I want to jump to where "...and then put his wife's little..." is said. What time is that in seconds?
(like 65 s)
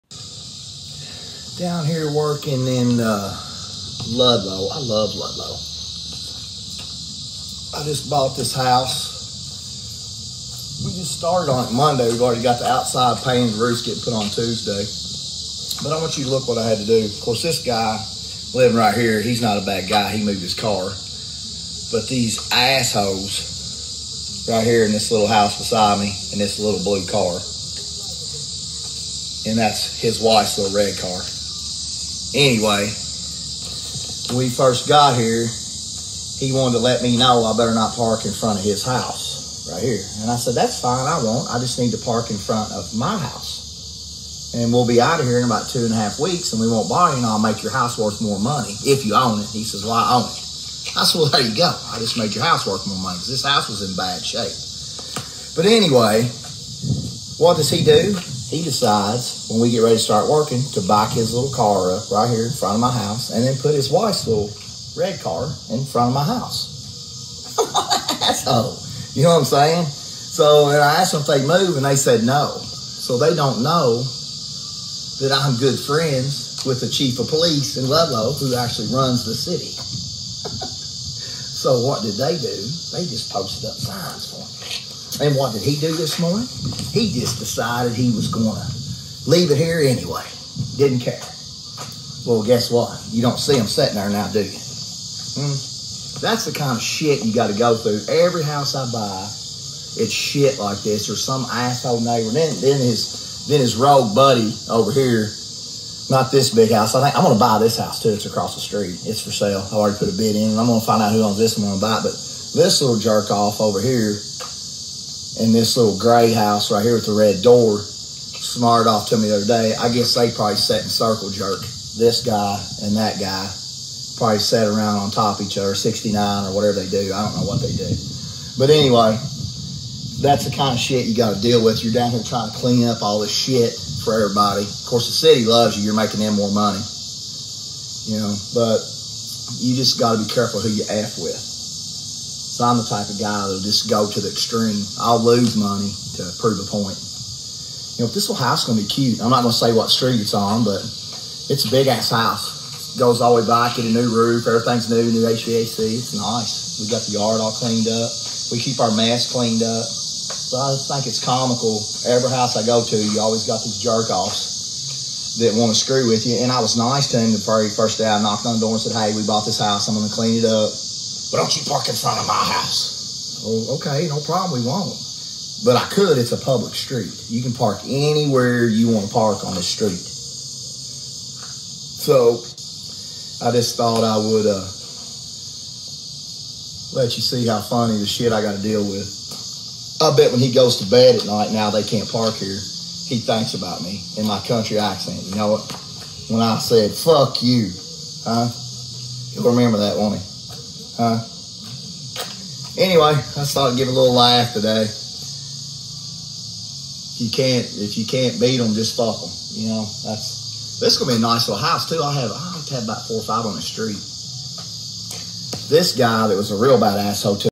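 63 s.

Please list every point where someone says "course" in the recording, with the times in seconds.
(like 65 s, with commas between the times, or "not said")
17 s, 134 s.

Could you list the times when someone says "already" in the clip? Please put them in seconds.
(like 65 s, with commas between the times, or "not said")
12 s, 109 s.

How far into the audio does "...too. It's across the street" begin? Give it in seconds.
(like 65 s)
108 s.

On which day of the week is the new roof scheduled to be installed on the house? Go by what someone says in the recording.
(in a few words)
Tuesday.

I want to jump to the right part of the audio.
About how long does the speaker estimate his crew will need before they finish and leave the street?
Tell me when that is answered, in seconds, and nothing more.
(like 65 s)
45 s.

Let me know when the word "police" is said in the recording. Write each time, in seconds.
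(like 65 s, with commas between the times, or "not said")
77 s.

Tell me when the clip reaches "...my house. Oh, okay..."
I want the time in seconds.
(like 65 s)
172 s.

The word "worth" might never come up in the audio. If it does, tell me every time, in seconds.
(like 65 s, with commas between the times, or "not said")
47 s, 52 s.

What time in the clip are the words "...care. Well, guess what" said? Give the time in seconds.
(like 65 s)
91 s.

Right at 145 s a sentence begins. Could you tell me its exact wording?
I'll lose money to prove a point.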